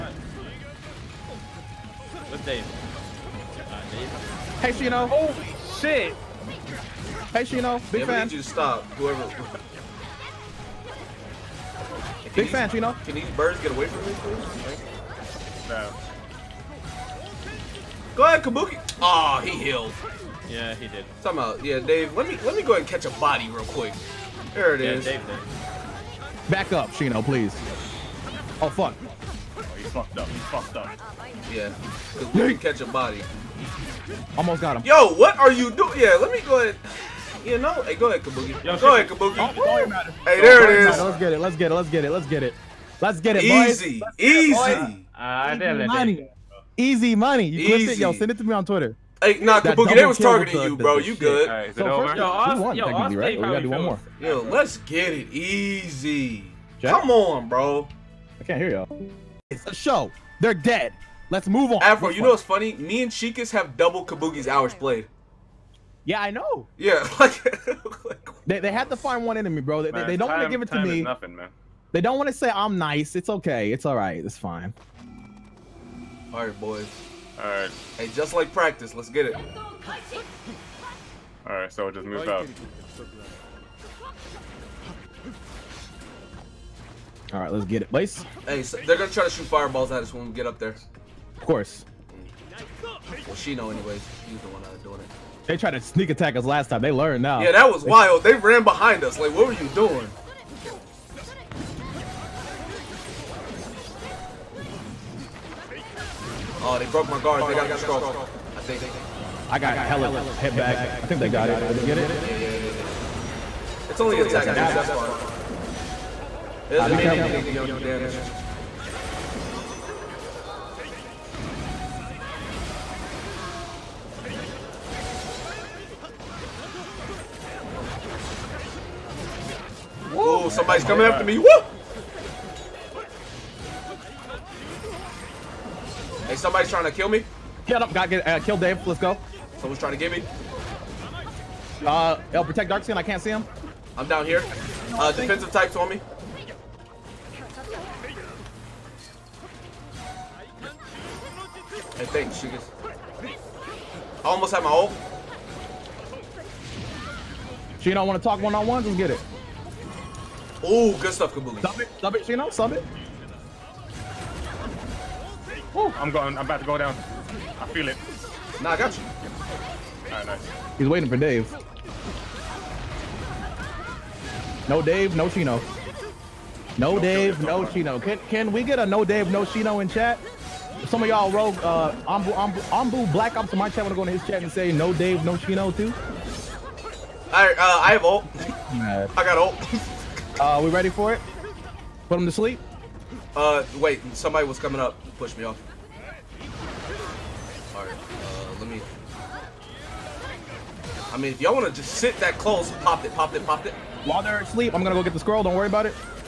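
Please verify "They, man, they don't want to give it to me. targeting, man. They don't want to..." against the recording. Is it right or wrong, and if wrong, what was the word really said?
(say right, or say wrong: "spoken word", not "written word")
wrong: "nothing", not "targeting".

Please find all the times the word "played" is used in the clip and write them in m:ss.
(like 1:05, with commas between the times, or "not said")
1:04.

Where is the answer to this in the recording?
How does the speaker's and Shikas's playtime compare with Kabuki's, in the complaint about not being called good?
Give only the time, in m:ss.
1:03.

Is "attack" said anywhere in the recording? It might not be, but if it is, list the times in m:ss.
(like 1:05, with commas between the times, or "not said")
1:36, 1:54.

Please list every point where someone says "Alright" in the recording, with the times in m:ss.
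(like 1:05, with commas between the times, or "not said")
1:17, 1:21, 1:27, 2:50, 3:17.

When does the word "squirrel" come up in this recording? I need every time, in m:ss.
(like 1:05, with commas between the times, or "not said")
3:25.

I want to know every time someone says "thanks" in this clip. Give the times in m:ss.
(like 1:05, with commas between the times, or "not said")
2:32.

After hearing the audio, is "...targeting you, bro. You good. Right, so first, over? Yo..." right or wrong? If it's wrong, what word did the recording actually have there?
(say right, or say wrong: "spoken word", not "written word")
right.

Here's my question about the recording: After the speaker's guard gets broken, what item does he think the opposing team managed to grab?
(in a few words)
the scroll.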